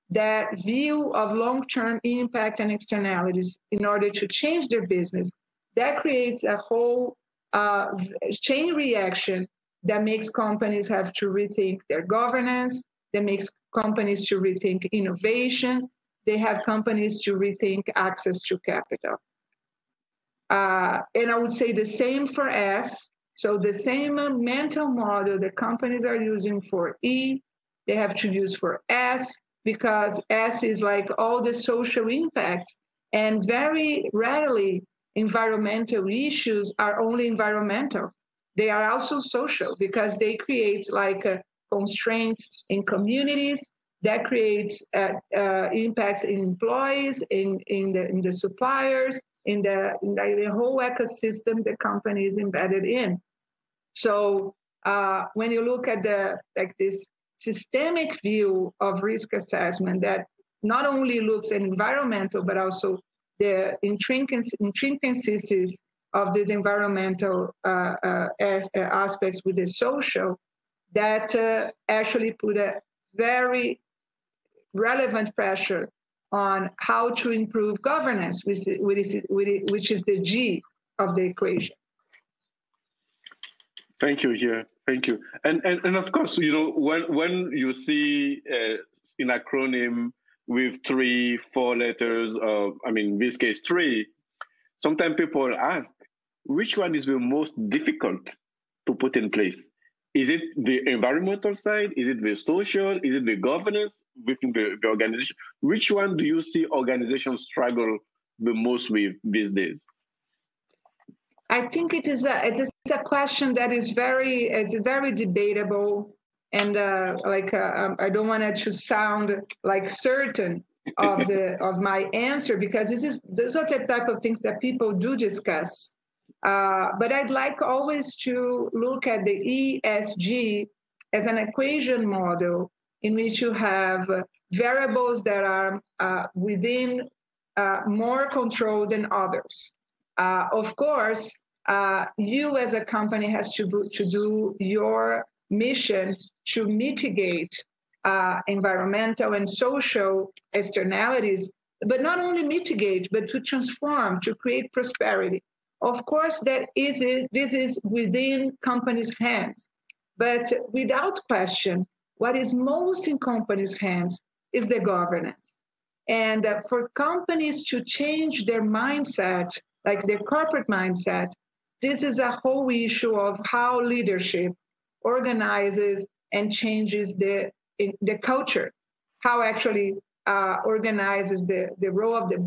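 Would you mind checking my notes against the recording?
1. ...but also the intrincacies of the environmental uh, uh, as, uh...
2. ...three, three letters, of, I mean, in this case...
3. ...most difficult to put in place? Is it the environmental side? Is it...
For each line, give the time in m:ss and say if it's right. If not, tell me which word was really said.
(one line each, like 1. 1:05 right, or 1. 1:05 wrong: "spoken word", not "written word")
1. 1:02 right
2. 1:30 wrong: "four", not "three"
3. 1:37 right.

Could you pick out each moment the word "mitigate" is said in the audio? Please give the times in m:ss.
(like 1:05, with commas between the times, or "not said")
2:26, 2:32.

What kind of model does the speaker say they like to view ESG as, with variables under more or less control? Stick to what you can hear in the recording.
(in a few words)
equation model.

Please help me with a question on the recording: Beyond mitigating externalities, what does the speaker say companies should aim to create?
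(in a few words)
prosperity.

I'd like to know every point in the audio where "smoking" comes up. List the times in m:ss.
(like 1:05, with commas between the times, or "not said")
not said.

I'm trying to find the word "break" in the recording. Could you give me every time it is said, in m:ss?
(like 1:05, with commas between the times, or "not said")
not said.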